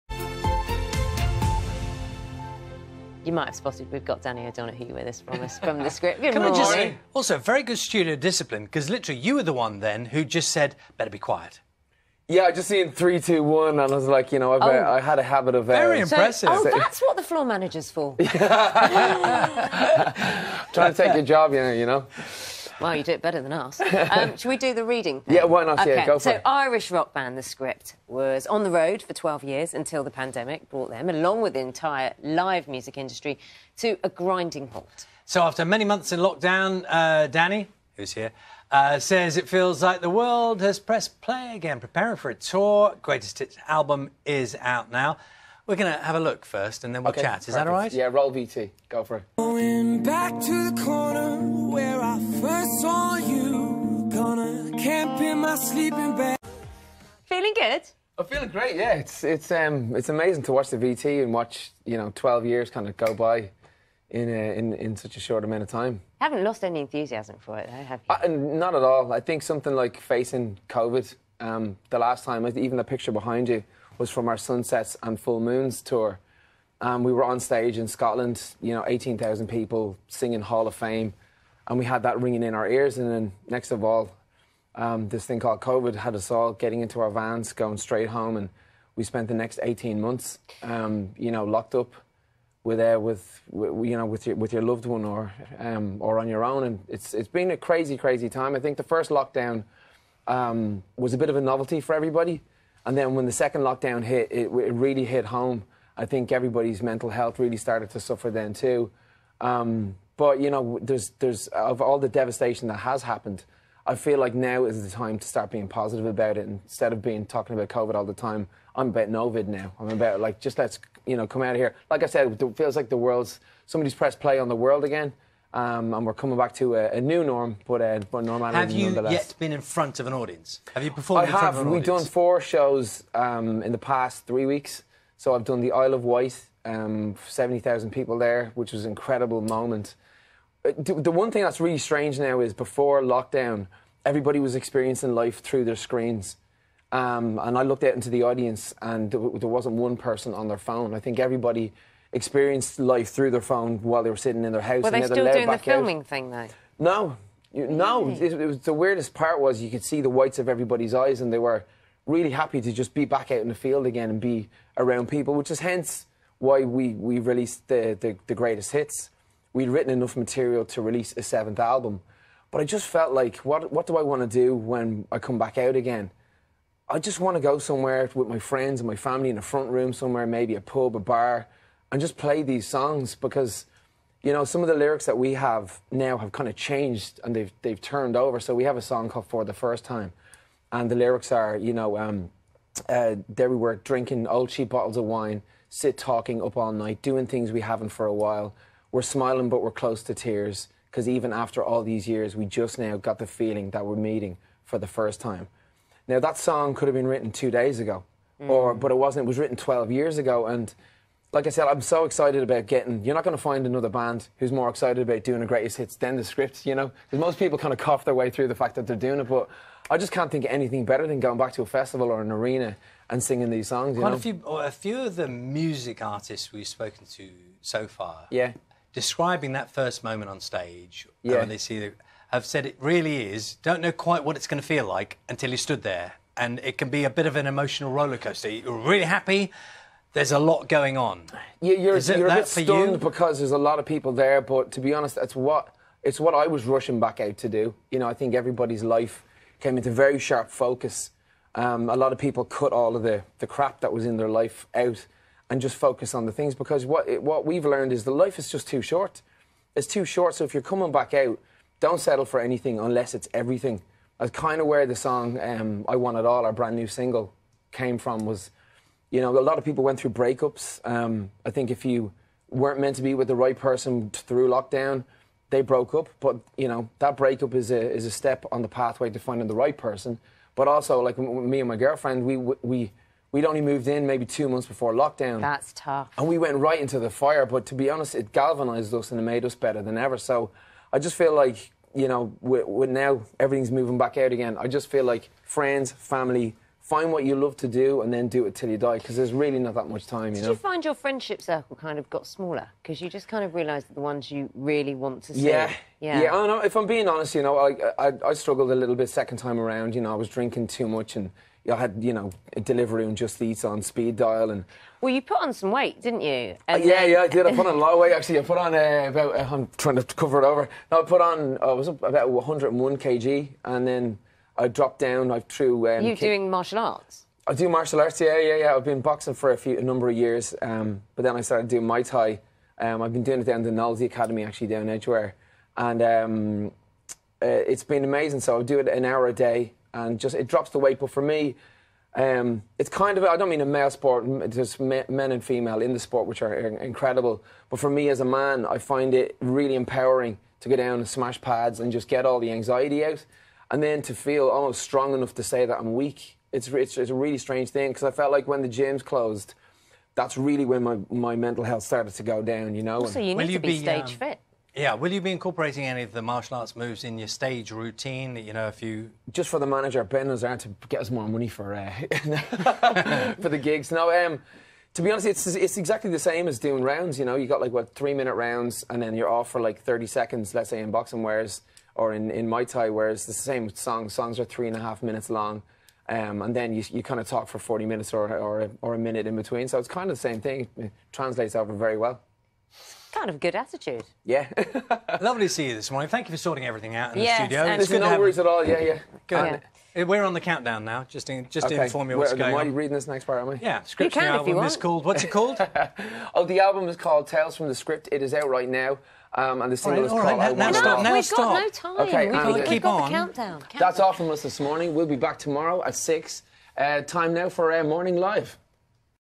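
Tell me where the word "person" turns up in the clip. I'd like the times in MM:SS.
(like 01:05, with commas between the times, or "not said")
02:29, 04:33, 04:39.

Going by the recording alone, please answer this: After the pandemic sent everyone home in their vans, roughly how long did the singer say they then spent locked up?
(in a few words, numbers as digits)
18 months.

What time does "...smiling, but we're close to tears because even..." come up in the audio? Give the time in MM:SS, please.
03:19.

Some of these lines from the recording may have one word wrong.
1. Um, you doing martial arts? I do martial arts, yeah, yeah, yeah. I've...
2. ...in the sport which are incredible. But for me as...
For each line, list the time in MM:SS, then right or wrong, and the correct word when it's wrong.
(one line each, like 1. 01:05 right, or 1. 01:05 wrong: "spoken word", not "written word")
1. 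05:25 right
2. 05:45 right.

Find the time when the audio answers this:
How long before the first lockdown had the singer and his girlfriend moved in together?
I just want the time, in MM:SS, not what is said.
04:44.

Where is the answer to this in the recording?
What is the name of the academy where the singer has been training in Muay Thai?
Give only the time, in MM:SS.
05:33.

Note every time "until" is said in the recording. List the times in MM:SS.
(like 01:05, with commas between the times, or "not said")
00:29, 03:55.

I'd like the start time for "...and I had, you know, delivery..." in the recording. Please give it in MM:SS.
05:11.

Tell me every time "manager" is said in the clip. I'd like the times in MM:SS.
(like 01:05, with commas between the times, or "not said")
00:17, 06:09.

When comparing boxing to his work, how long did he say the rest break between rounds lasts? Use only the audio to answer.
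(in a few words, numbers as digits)
30 seconds.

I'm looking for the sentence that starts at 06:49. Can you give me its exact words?
Um, and the single right, is called right, now, now stop, now We've stop.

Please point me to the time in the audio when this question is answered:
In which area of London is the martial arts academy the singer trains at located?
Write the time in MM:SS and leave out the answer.
05:34.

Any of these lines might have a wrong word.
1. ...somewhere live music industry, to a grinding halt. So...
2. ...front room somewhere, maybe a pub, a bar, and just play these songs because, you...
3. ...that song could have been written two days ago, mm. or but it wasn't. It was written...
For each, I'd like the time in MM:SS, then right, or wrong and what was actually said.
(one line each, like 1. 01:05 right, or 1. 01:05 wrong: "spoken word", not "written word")
1. 00:31 wrong: "entire", not "somewhere"
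2. 02:59 right
3. 03:26 right.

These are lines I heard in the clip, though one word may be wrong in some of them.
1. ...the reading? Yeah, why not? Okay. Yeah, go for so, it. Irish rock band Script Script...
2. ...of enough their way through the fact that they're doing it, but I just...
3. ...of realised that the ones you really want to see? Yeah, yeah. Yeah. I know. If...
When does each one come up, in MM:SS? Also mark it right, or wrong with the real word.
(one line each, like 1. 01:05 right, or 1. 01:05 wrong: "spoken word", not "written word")
1. 00:24 wrong: "The", not "Script"
2. 03:37 wrong: "cough", not "enough"
3. 05:03 right.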